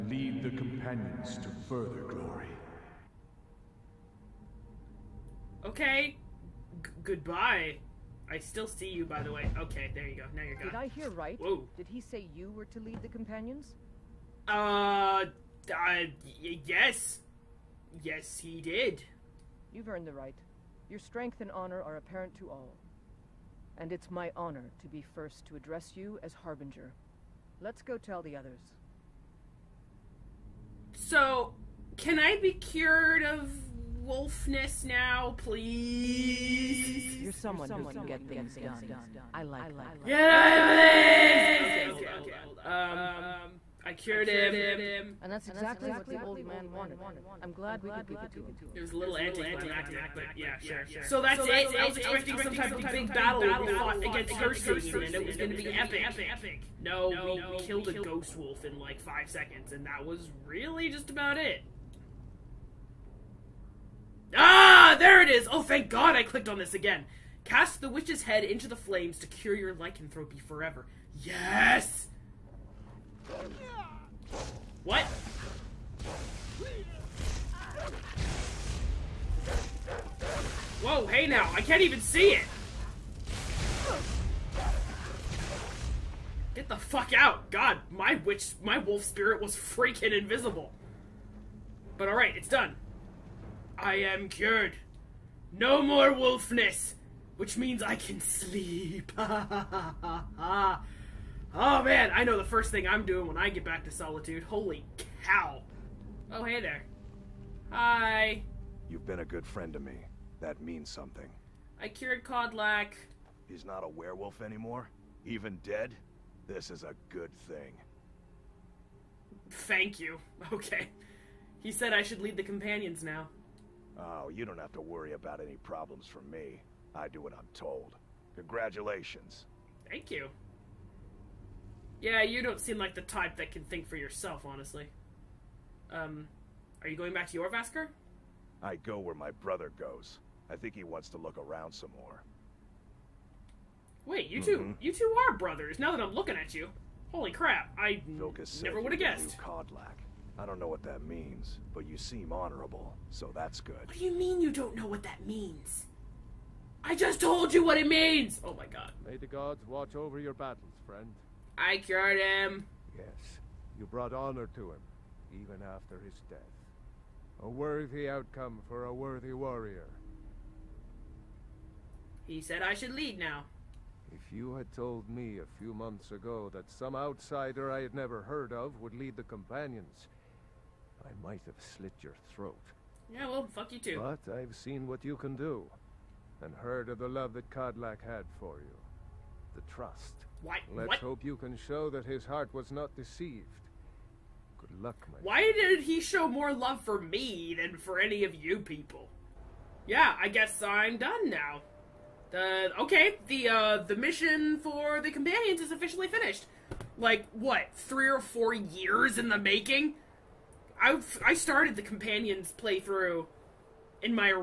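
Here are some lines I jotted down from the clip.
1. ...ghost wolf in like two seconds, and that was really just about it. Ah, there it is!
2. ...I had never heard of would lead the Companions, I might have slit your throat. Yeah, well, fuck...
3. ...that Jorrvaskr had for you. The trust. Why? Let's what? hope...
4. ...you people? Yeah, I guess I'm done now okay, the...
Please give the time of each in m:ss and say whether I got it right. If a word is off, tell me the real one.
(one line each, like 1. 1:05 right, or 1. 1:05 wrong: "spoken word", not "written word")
1. 0:57 wrong: "five", not "two"
2. 2:57 right
3. 3:07 wrong: "Kodlak", not "Jorrvaskr"
4. 3:18 right.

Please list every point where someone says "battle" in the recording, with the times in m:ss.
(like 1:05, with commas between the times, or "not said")
0:53, 2:40.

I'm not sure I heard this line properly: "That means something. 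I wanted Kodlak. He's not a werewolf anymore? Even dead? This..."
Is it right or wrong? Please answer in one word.
wrong.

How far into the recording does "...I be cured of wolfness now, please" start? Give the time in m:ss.
0:32.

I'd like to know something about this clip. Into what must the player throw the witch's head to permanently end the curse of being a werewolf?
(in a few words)
the flames.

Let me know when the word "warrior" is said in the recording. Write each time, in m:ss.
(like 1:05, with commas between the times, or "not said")
2:49.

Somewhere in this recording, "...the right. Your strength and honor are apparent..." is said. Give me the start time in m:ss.
0:20.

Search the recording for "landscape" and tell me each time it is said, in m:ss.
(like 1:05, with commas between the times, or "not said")
not said.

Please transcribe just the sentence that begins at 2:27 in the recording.
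I Vilkas never would have guessed.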